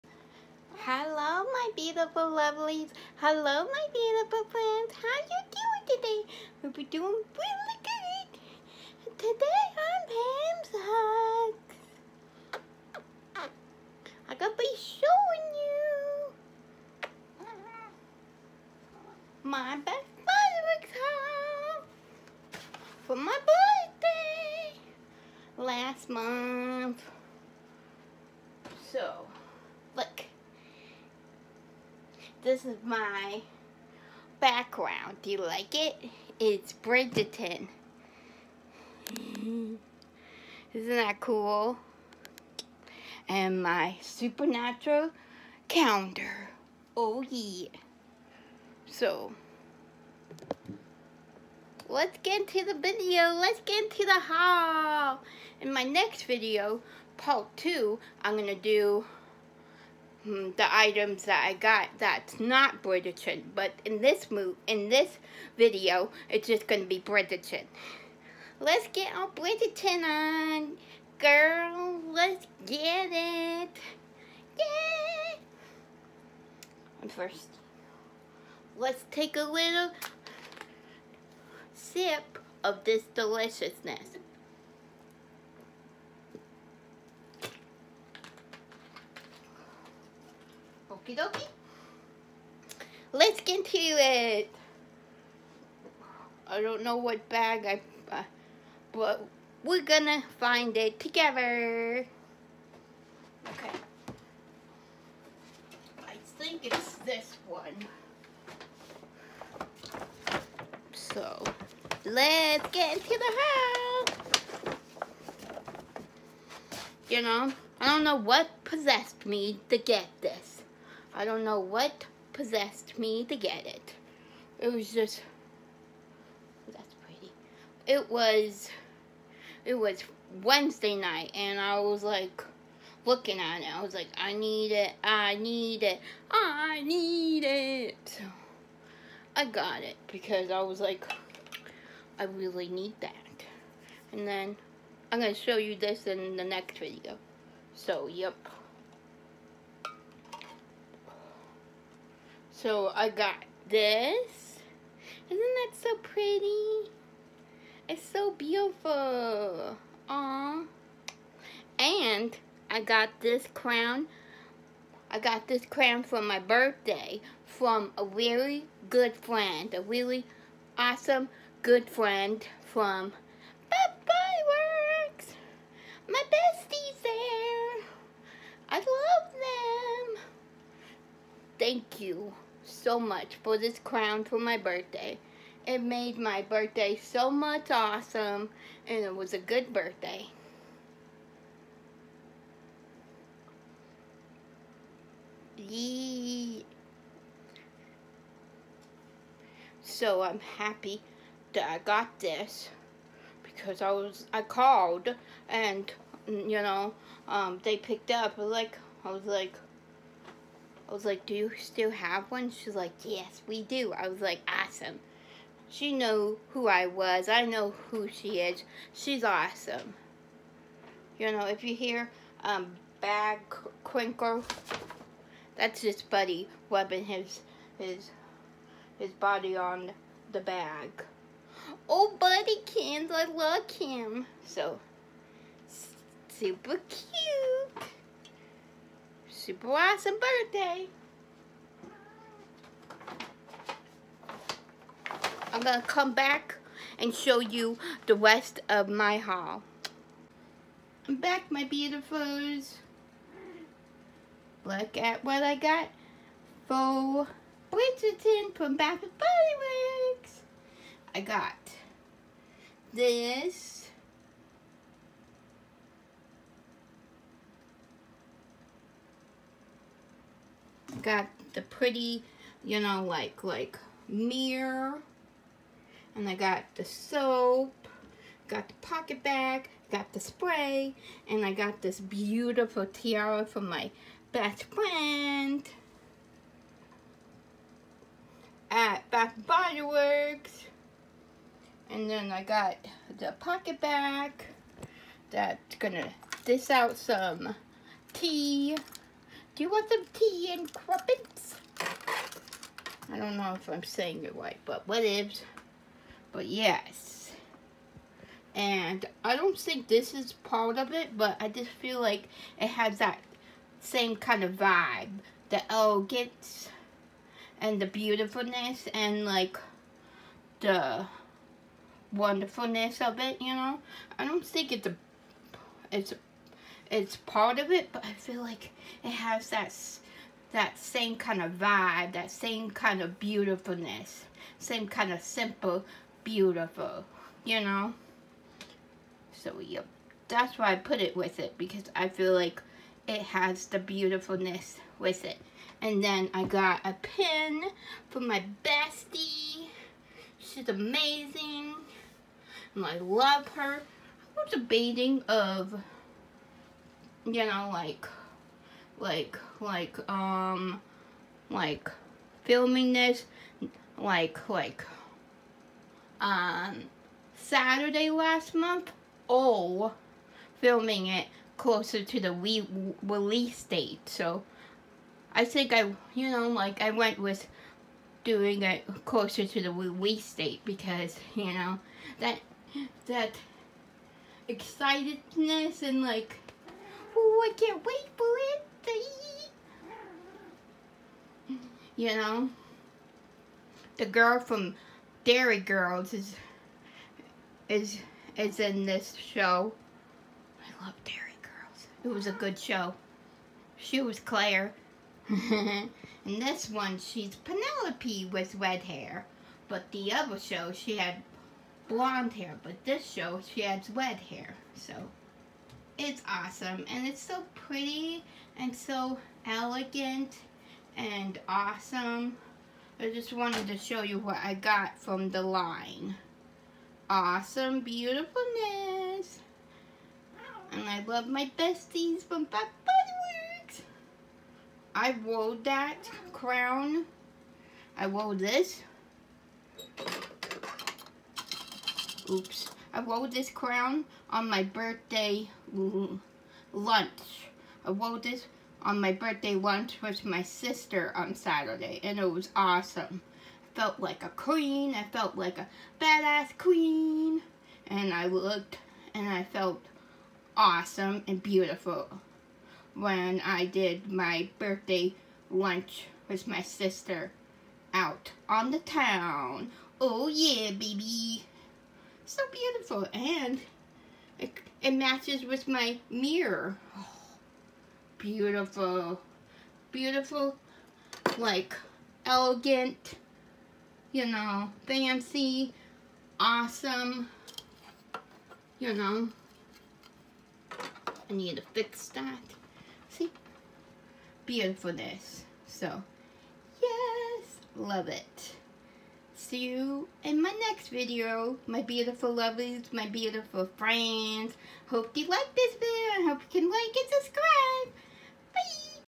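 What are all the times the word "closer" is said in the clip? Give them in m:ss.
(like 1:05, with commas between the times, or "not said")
6:11, 6:19.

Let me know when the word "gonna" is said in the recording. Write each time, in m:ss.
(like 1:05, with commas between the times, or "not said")
1:39, 4:55.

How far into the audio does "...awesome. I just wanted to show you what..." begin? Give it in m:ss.
7:01.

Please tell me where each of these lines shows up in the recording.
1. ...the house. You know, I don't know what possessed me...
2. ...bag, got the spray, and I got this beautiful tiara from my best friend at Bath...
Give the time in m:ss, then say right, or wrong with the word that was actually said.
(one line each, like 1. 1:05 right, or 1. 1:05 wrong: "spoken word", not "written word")
1. 1:53 right
2. 4:39 right.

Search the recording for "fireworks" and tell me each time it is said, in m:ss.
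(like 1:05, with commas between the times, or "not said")
0:20, 2:54.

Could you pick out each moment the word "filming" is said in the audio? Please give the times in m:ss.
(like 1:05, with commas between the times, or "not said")
6:02, 6:10.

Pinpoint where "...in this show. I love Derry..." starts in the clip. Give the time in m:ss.
6:38.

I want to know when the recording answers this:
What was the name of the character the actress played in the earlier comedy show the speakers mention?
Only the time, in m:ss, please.
6:44.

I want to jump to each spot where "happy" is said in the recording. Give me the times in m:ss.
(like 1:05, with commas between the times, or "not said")
3:20.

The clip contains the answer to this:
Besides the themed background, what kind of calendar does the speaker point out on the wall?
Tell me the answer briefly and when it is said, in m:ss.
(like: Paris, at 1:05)
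Supernatural, at 0:44.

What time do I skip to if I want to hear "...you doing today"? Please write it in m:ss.
0:05.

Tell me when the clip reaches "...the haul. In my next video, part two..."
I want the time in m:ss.
0:54.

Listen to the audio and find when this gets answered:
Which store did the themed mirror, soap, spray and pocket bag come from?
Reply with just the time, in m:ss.
4:18.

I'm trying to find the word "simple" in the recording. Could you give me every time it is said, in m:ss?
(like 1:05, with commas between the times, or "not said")
5:35.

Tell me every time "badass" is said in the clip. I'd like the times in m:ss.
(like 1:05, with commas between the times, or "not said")
7:36.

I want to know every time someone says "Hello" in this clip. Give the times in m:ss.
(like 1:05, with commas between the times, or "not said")
0:03.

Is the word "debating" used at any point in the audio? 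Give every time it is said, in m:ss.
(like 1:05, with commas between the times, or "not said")
5:54.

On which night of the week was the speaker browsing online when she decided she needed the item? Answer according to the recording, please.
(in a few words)
Wednesday.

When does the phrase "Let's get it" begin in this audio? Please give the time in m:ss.
1:12.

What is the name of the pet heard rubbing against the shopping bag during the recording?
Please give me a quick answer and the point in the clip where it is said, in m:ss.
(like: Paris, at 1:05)
Buddy, at 3:46.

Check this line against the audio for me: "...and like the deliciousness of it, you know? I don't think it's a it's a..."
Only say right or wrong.
wrong.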